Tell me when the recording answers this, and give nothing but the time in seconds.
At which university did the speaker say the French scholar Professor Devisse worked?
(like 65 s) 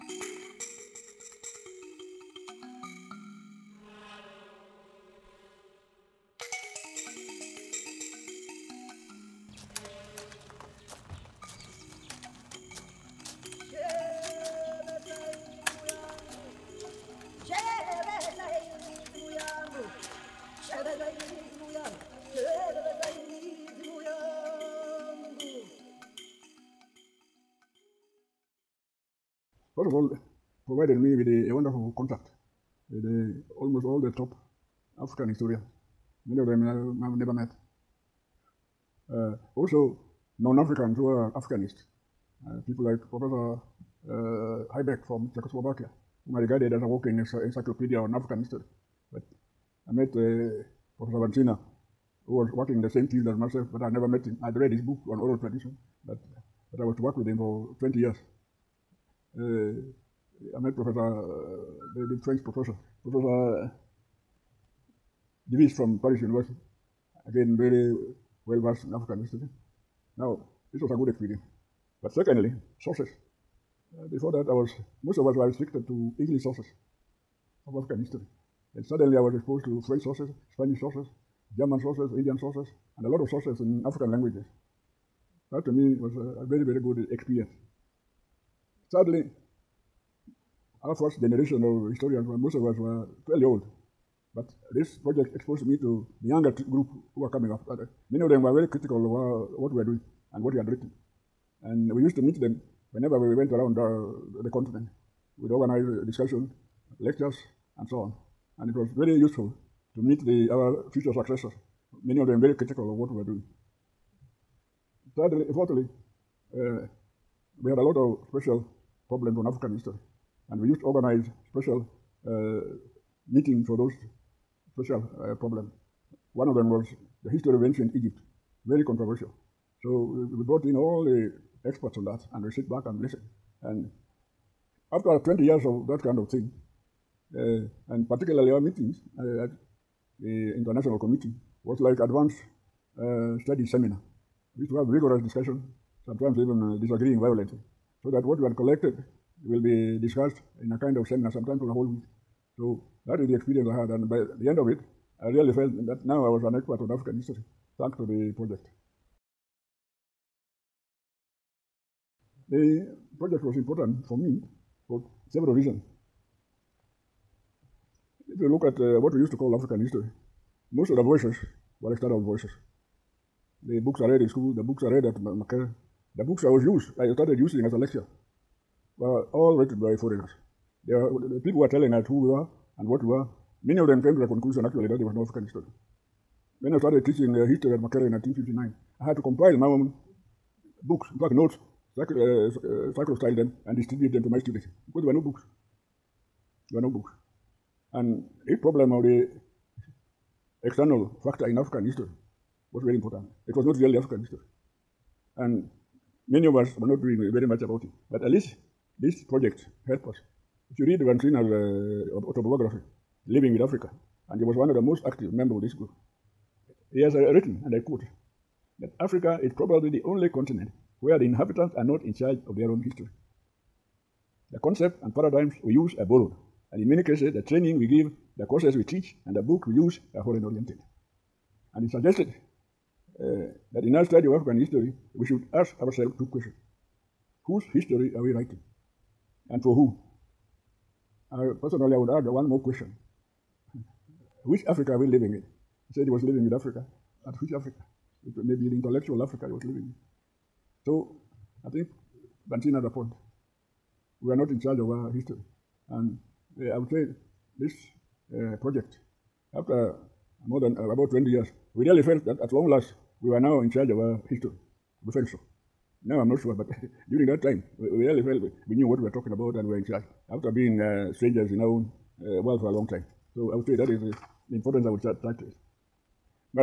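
66 s.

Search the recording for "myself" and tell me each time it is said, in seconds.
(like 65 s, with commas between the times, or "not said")
53 s.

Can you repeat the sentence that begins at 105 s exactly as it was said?
We'd organize discussions, lectures, and so on.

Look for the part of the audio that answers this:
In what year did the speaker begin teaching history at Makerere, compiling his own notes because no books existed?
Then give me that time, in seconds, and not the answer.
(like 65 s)
188 s.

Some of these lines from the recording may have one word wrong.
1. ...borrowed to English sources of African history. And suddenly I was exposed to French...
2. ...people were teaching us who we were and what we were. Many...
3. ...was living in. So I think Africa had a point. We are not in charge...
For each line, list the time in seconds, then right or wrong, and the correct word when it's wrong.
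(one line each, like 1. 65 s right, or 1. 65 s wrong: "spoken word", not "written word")
1. 75 s wrong: "restricted", not "borrowed"
2. 181 s wrong: "telling", not "teaching"
3. 249 s wrong: "Bantin", not "Africa".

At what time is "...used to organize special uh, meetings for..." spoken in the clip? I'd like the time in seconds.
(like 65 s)
120 s.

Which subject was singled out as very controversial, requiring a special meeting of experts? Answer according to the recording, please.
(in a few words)
History of ancient Egypt.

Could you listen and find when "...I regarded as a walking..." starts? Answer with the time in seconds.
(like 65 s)
46 s.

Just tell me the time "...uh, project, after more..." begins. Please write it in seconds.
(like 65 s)
258 s.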